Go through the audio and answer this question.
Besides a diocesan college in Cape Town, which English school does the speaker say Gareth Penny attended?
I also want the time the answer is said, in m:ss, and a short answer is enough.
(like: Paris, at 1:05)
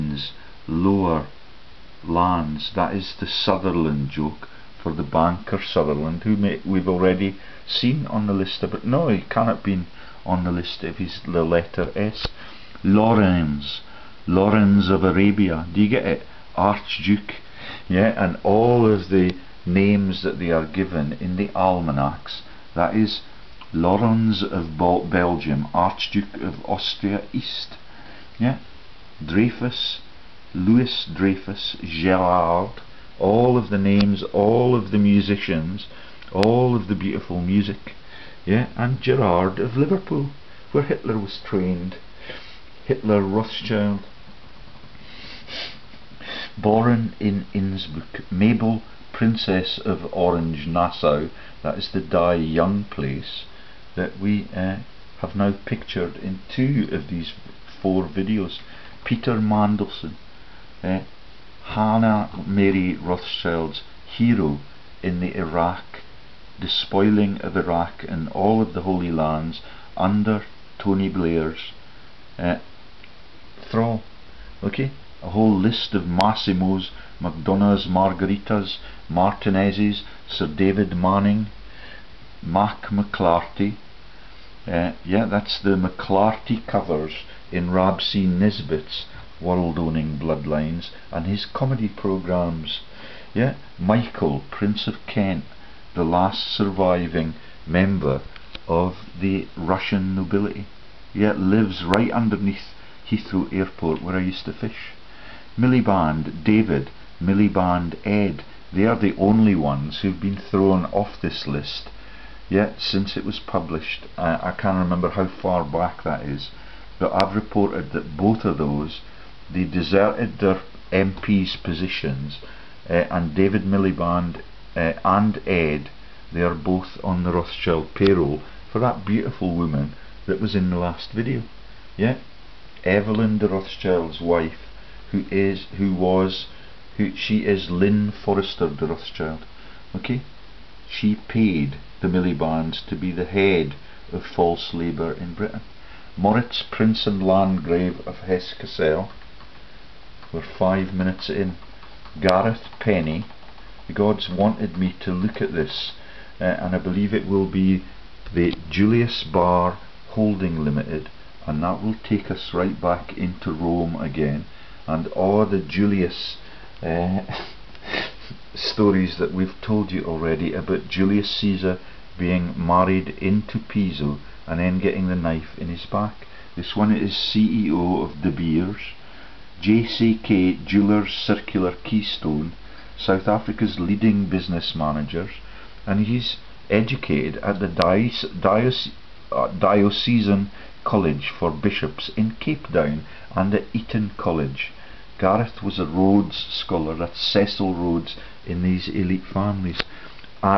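Eton College, at 3:13.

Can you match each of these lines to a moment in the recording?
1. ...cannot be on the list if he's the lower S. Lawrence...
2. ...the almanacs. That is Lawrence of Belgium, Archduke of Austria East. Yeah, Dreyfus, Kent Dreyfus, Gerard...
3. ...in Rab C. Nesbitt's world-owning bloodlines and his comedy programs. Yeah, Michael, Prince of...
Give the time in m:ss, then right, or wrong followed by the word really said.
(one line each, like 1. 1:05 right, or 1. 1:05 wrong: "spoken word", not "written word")
1. 0:09 wrong: "letter", not "lower"
2. 0:21 wrong: "Louis", not "Kent"
3. 1:27 right.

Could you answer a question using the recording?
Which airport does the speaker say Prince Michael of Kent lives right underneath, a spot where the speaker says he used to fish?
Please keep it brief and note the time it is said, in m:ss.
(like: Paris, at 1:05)
Heathrow Airport, at 1:43.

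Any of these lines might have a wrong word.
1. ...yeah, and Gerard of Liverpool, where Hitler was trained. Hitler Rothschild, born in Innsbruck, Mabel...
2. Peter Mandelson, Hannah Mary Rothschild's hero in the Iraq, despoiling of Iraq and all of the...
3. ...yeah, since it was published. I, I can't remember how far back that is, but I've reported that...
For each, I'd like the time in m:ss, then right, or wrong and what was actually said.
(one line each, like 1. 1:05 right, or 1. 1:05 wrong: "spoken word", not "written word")
1. 0:38 right
2. 0:59 right
3. 1:52 right.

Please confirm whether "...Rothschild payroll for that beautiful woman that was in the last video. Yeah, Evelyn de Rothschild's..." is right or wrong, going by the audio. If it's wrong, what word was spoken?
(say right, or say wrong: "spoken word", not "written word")
right.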